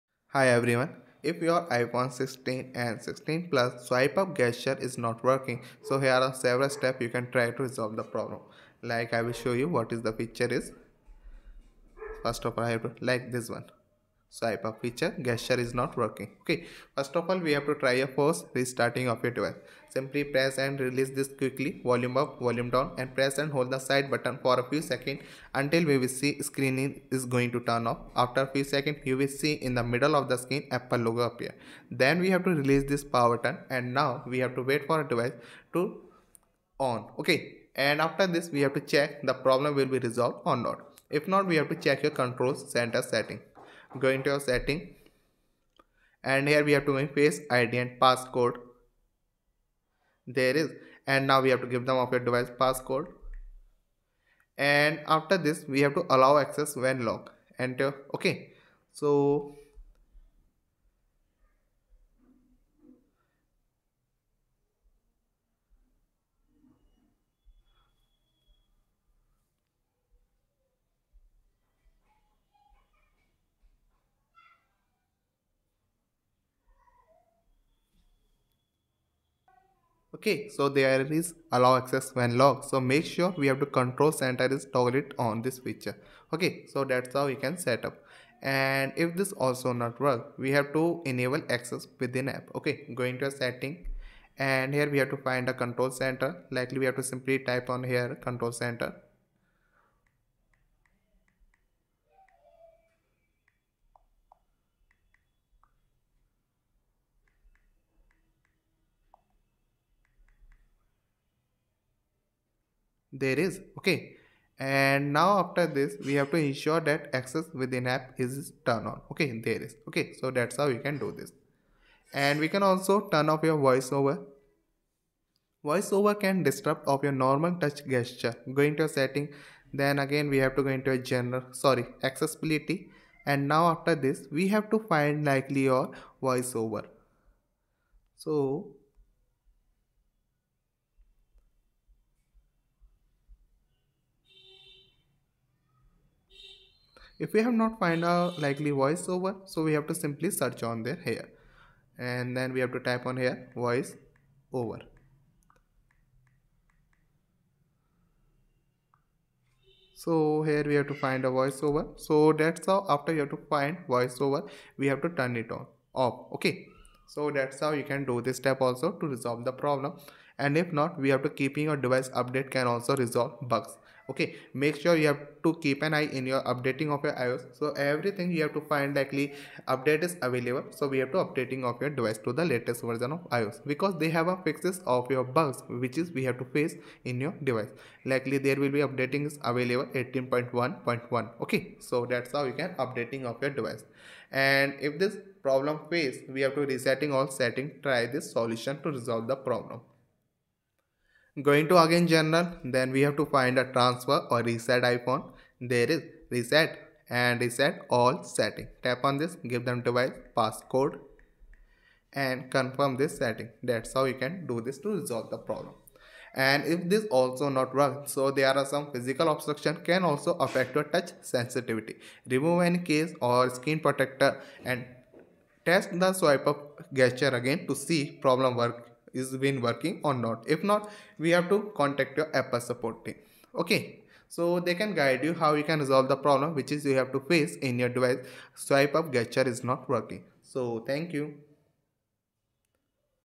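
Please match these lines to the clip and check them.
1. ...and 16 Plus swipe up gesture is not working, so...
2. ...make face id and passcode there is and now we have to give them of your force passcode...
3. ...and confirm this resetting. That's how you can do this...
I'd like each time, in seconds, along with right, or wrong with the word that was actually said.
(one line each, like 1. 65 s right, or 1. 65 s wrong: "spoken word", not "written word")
1. 2 s right
2. 46 s wrong: "device", not "force"
3. 212 s wrong: "setting", not "resetting".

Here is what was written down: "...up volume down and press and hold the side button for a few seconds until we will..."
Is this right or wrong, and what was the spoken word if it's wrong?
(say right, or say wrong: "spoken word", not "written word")
right.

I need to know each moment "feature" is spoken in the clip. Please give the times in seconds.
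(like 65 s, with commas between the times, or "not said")
10 s, 14 s, 85 s.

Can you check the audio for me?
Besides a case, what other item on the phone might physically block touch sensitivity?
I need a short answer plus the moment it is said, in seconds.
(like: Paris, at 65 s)
Skin protector, at 223 s.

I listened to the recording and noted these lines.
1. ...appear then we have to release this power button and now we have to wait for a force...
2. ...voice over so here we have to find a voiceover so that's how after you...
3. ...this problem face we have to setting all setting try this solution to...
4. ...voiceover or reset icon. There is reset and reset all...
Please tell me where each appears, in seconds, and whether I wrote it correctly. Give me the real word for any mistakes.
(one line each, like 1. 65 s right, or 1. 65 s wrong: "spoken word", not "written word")
1. 31 s wrong: "device", not "force"
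2. 153 s right
3. 195 s wrong: "resetting", not "setting"
4. 203 s wrong: "transfer", not "voiceover".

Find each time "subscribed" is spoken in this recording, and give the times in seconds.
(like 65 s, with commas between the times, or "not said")
not said.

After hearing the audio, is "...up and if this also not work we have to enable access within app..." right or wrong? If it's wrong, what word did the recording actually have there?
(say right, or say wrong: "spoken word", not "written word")
right.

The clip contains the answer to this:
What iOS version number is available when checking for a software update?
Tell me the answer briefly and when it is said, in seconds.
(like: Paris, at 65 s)
18.1.1, at 190 s.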